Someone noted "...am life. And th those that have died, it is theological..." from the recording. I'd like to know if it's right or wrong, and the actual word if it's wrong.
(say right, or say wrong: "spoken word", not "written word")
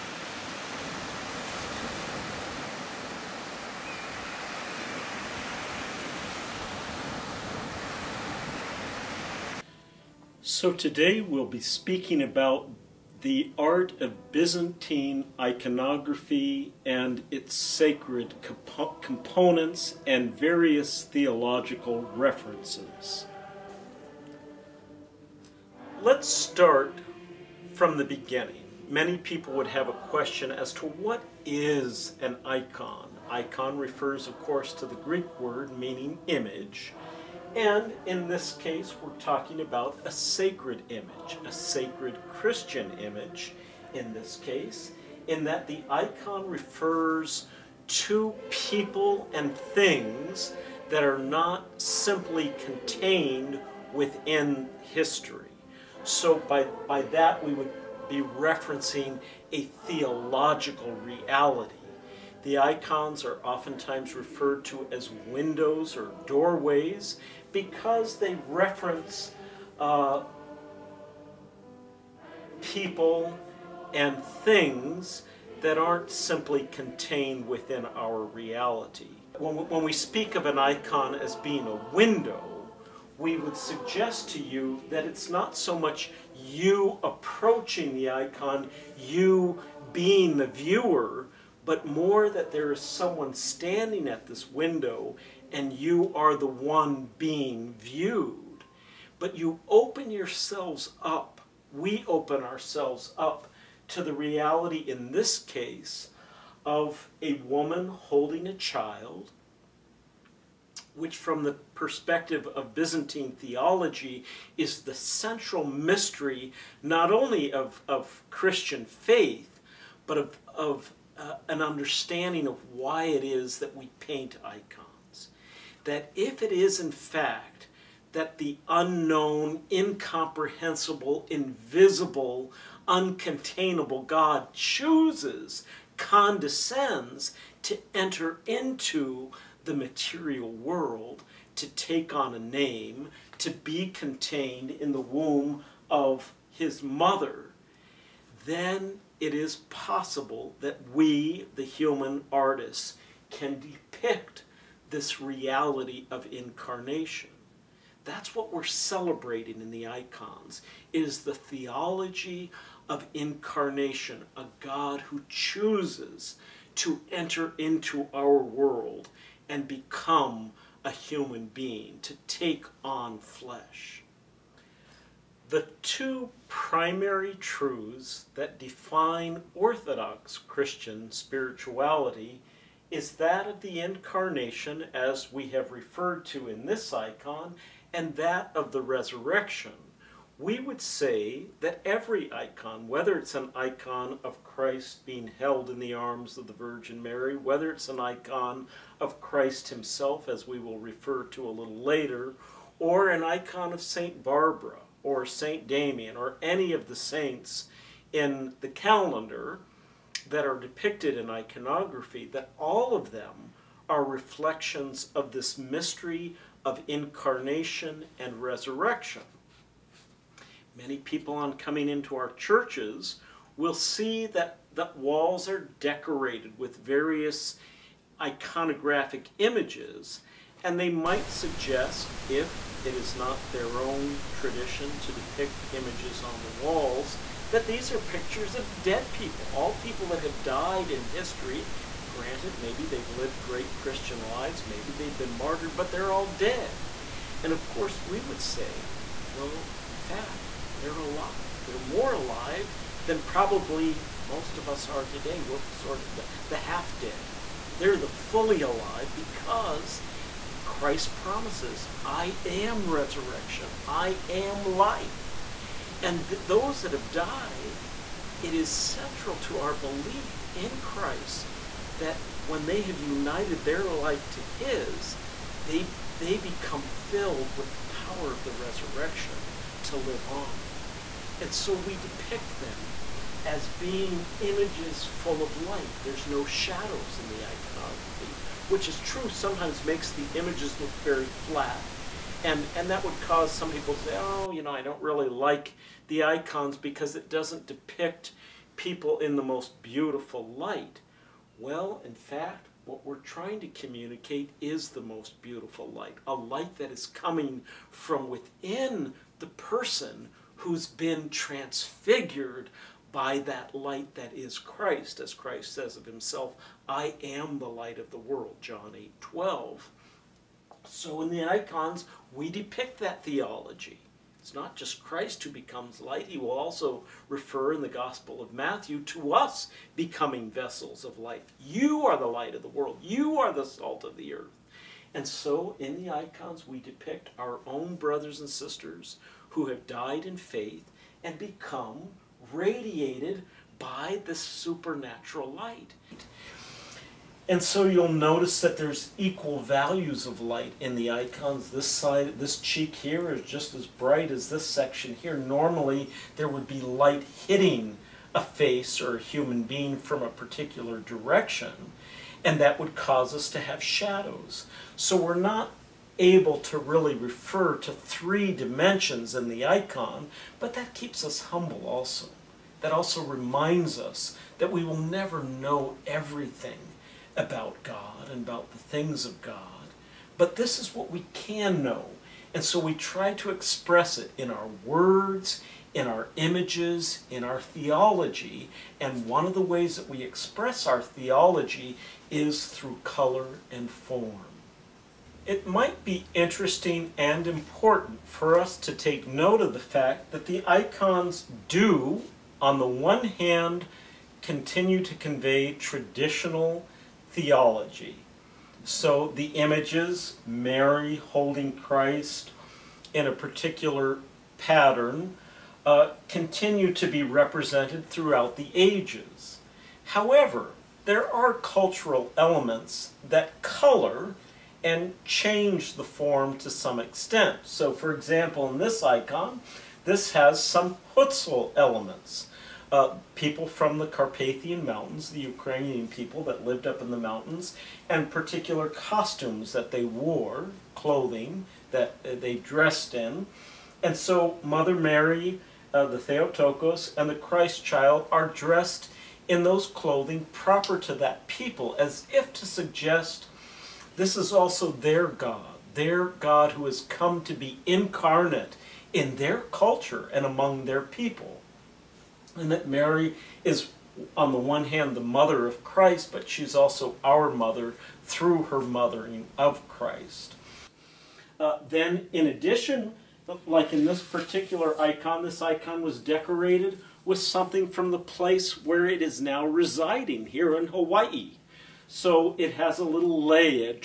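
wrong: "central", not "theological".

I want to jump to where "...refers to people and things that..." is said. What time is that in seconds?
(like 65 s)
46 s.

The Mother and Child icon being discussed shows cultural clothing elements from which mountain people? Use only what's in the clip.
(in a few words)
Hutsul.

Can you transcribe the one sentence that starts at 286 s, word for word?
There's no shadows in the iconography, which is true, sometimes makes the images look very flat.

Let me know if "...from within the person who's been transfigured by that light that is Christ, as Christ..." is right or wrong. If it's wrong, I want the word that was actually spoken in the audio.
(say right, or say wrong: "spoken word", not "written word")
right.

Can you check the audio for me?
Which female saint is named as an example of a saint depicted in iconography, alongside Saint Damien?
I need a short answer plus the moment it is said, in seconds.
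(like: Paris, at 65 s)
St. Barbara, at 203 s.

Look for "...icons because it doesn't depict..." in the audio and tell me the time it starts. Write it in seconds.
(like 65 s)
296 s.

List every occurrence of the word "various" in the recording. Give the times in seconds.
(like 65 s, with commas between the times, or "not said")
20 s, 226 s.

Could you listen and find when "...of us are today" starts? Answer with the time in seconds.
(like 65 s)
254 s.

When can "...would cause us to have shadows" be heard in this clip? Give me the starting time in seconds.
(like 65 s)
362 s.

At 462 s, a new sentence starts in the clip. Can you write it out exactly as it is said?
And that Mary is, on the one hand, the mother of Christ, but she's also our mother through her mothering of Christ.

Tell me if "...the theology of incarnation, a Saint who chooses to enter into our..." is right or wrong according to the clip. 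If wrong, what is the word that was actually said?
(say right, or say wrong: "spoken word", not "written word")
wrong: "God", not "Saint".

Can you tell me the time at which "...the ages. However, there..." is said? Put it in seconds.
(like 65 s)
418 s.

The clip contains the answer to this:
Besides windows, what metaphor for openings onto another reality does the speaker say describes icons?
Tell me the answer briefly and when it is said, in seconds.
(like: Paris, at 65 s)
doorways, at 66 s.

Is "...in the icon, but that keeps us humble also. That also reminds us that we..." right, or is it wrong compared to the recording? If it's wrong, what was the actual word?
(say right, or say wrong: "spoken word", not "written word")
right.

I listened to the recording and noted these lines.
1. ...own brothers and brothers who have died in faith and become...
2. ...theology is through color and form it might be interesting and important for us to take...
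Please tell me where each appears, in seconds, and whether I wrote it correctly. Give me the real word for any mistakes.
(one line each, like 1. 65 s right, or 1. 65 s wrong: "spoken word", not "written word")
1. 337 s wrong: "sisters", not "brothers"
2. 391 s right.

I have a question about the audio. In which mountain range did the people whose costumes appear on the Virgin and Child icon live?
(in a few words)
Carpathian Mountains.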